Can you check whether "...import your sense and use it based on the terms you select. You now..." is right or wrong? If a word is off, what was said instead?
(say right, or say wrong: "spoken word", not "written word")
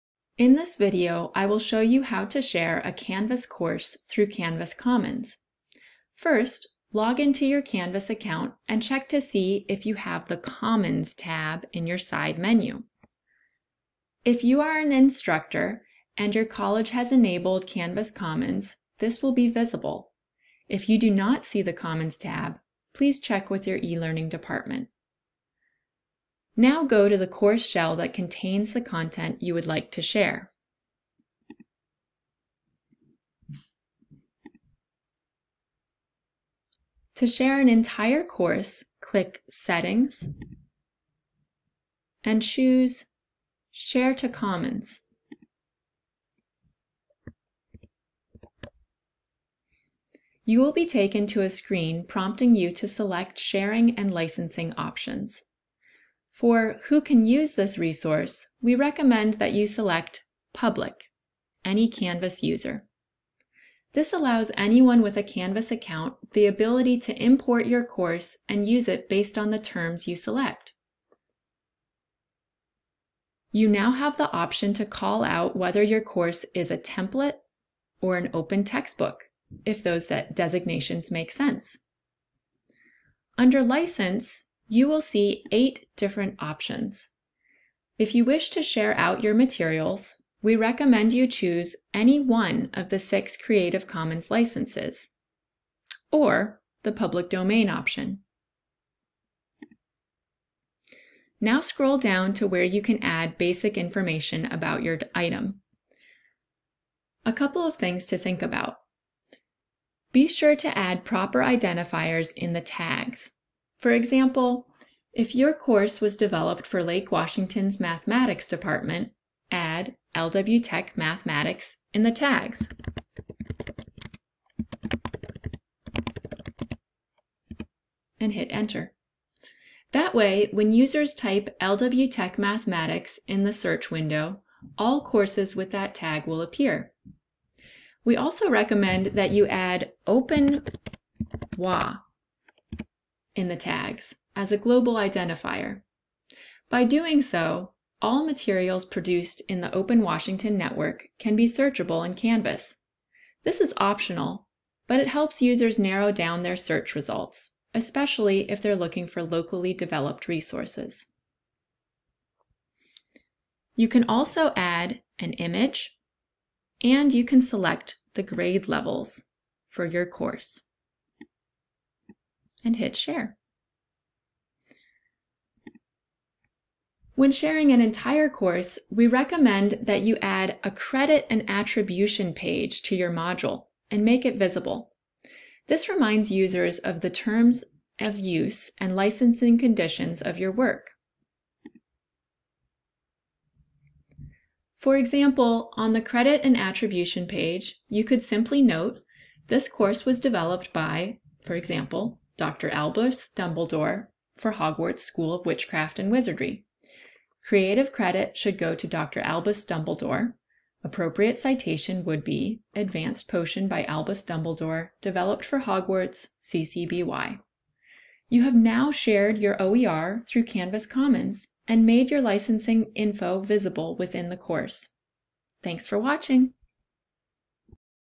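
wrong: "course", not "sense".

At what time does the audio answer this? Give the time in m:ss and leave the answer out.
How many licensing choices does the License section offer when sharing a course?
1:25.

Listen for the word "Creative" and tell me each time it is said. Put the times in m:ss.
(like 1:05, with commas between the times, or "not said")
1:33, 3:27.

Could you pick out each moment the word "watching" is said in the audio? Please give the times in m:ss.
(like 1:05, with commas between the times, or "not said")
3:45.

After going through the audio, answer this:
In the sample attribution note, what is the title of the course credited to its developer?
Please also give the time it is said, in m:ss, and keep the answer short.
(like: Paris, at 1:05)
Advanced Potion, at 3:32.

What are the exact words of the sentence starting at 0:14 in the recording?
If you are an instructor and your college has enabled Canvas Commons, this will be visible.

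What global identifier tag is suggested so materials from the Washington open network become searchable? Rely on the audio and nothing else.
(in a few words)
Open WA.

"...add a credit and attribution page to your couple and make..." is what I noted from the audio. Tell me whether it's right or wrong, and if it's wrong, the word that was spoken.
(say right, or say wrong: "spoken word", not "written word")
wrong: "module", not "couple".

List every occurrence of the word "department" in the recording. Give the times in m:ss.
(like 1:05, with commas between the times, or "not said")
0:24, 1:58.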